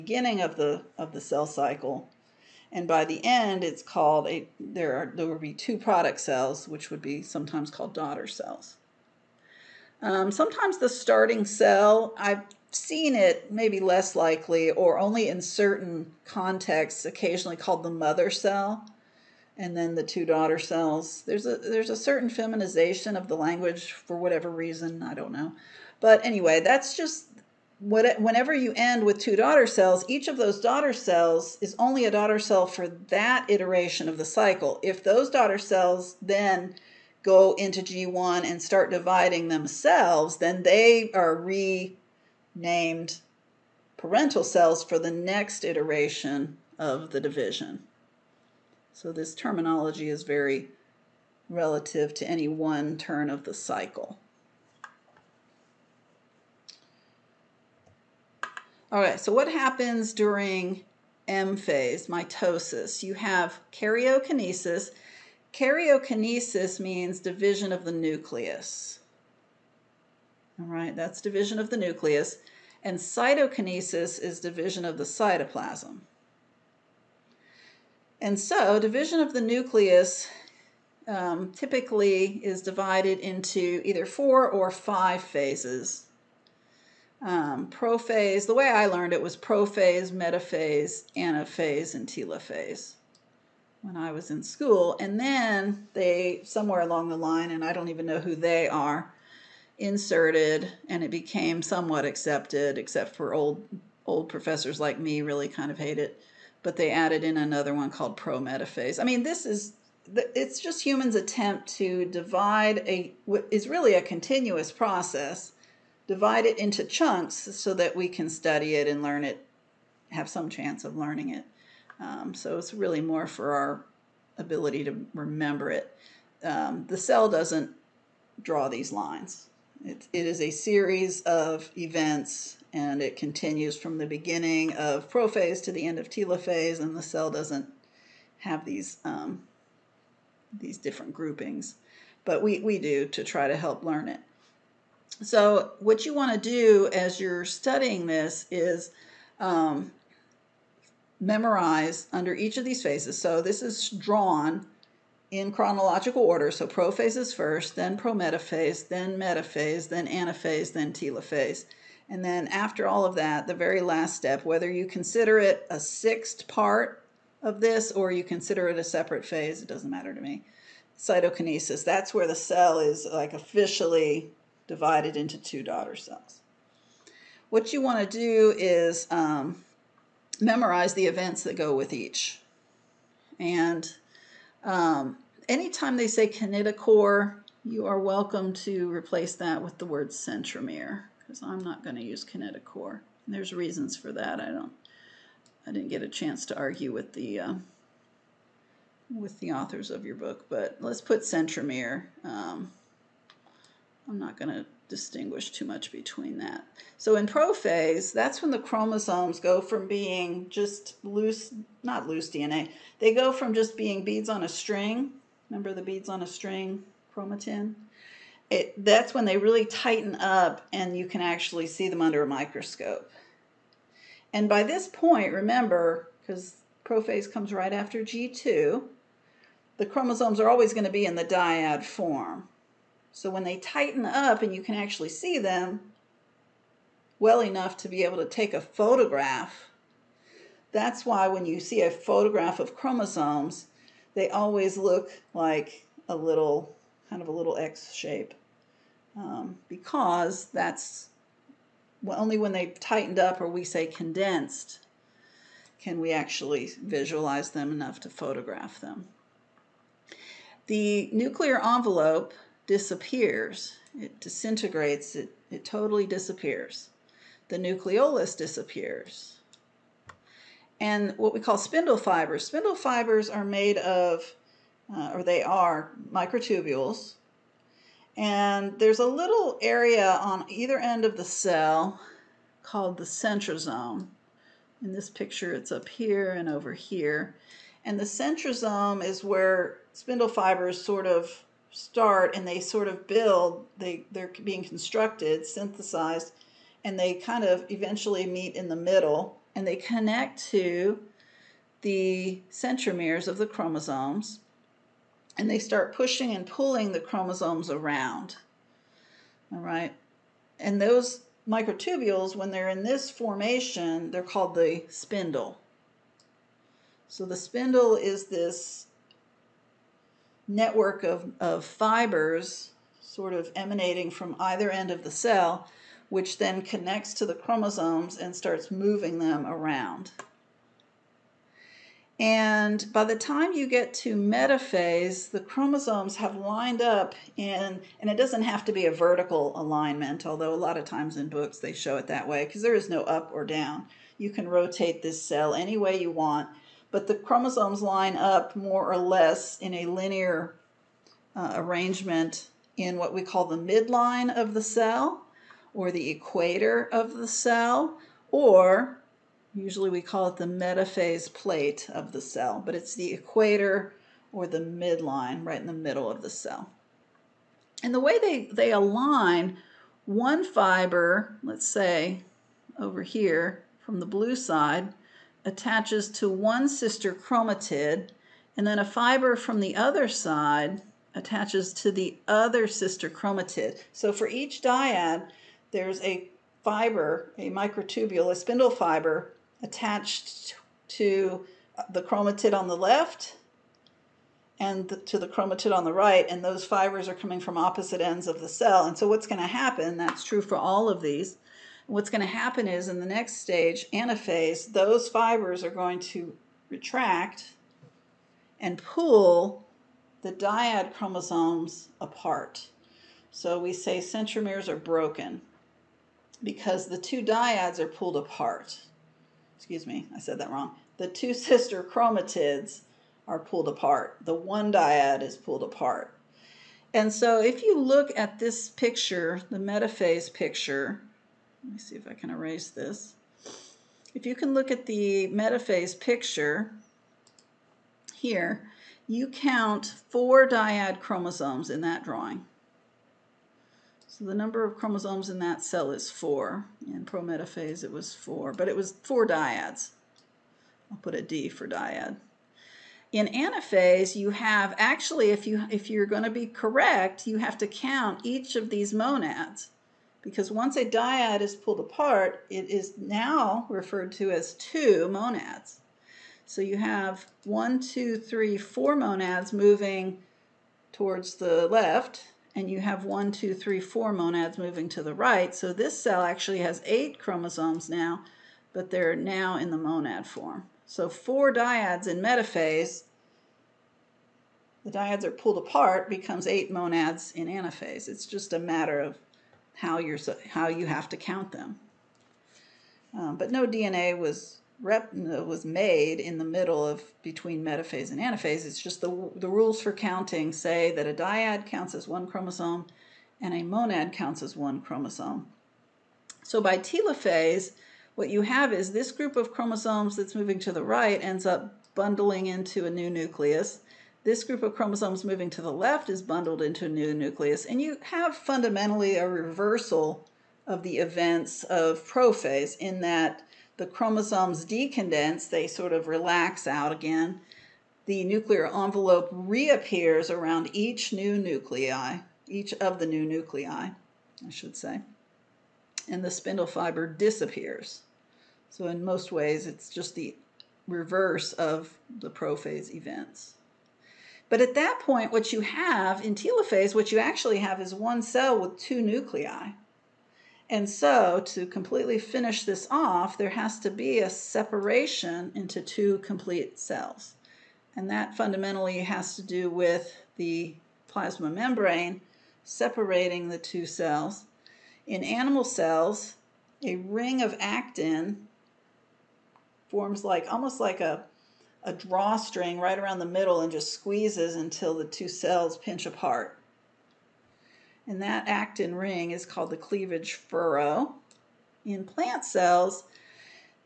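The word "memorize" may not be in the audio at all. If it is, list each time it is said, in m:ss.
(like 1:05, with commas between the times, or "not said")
2:31, 3:00.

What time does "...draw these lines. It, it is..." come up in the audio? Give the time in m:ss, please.
2:08.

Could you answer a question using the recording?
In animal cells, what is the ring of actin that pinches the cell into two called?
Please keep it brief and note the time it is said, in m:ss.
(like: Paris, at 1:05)
cleavage furrow, at 9:39.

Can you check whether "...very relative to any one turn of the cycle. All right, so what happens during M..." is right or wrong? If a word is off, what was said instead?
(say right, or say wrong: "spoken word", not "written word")
right.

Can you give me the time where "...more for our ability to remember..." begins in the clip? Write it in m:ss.
2:03.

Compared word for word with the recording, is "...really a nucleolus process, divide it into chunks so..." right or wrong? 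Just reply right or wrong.
wrong.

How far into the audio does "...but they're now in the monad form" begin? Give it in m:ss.
7:58.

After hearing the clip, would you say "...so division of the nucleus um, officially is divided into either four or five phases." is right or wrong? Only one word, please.
wrong.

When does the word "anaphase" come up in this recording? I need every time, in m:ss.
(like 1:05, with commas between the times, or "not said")
1:31, 2:40, 6:43, 7:33, 8:07, 8:18.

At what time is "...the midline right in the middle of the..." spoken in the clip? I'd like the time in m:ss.
6:04.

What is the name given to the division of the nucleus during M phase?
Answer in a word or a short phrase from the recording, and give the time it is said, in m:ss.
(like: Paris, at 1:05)
karyokinesis, at 1:05.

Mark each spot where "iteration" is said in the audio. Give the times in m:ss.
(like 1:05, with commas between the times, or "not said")
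0:33, 0:45.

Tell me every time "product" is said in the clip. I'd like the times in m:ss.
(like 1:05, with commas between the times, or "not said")
0:05.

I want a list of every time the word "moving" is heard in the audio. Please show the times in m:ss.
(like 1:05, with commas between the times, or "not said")
5:28, 7:49, 7:54, 8:30, 8:35.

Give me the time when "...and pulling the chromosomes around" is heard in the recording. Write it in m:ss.
5:06.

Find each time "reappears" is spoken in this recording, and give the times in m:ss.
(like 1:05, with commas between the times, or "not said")
8:49.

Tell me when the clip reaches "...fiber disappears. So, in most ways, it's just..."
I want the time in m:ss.
8:56.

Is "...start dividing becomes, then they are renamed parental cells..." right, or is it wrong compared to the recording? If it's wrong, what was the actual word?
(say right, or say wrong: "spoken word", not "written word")
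wrong: "themselves", not "becomes".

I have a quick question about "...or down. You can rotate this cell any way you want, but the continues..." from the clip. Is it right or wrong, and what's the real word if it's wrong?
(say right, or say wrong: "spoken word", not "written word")
wrong: "chromosomes", not "continues".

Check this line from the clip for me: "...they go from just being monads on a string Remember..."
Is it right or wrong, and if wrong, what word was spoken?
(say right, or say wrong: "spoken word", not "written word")
wrong: "beads", not "monads".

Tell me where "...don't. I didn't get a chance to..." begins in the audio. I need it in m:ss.
3:14.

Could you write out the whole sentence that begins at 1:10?
All right, that's division of the nucleus.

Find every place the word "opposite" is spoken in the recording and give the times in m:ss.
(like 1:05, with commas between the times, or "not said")
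6:37.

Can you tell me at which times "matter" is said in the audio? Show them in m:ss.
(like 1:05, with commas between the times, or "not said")
2:49, 8:08.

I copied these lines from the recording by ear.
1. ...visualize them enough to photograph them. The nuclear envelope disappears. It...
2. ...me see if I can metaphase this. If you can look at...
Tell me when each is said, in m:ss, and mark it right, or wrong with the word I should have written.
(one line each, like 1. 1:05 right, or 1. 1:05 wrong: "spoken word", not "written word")
1. 4:16 right
2. 7:11 wrong: "erase", not "metaphase".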